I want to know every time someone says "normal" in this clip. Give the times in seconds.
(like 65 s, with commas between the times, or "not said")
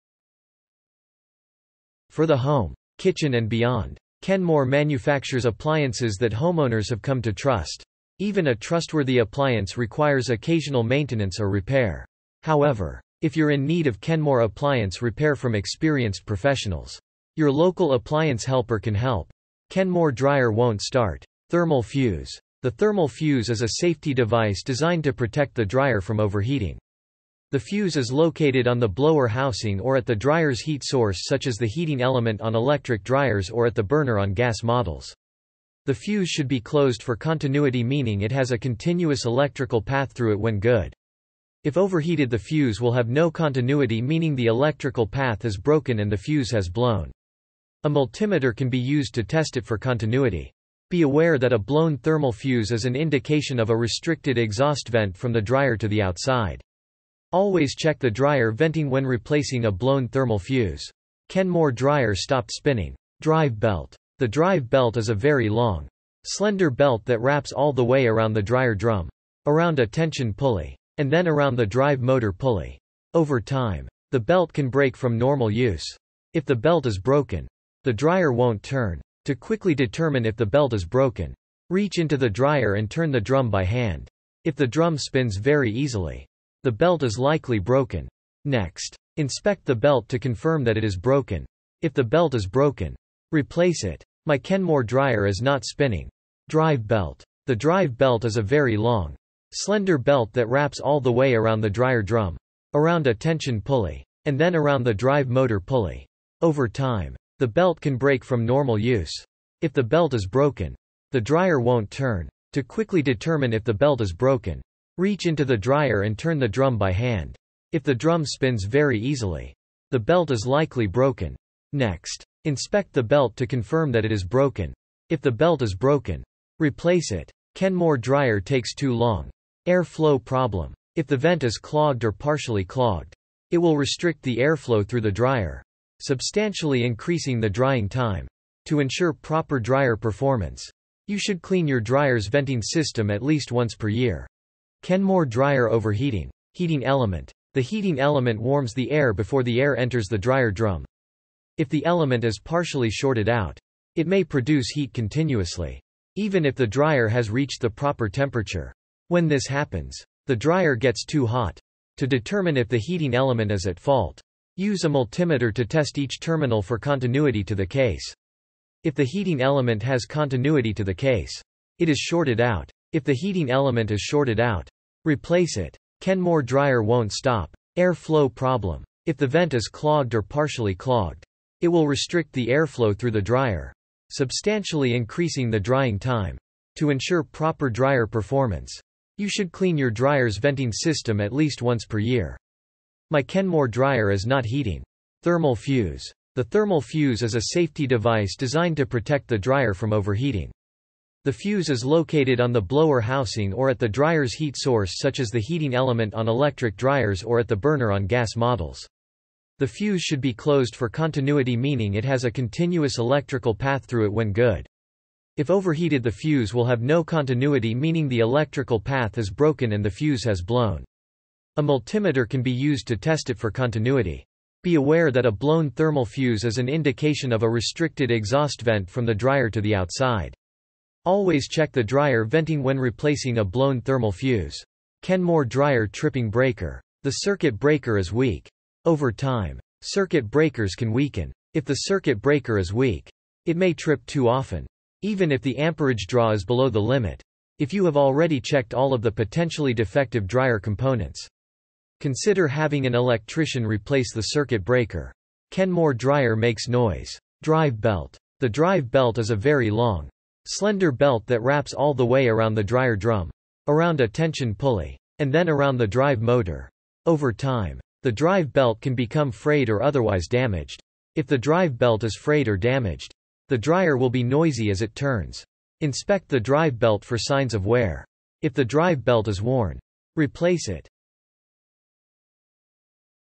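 75 s, 108 s.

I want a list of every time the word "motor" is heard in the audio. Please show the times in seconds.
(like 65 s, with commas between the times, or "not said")
72 s, 105 s, 266 s.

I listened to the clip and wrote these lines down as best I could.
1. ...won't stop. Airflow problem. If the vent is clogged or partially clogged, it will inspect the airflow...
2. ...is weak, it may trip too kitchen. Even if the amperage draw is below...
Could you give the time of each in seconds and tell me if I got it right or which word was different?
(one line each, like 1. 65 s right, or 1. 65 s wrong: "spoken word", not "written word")
1. 176 s wrong: "restrict", not "inspect"
2. 242 s wrong: "often", not "kitchen".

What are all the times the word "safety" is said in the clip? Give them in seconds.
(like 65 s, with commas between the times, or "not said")
23 s, 197 s.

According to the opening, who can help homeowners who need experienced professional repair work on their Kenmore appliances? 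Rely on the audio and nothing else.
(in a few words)
local appliance helper.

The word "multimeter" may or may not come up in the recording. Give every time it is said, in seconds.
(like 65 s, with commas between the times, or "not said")
47 s, 164 s, 221 s.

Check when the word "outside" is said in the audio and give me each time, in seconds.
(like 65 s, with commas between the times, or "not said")
56 s, 229 s.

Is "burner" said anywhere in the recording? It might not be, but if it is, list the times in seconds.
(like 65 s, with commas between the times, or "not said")
33 s, 207 s.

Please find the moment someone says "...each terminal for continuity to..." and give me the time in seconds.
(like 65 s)
165 s.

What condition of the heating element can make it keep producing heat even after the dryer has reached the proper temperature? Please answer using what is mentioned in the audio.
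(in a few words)
partially shorted out.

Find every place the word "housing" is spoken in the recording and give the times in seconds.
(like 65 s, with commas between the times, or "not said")
29 s, 202 s.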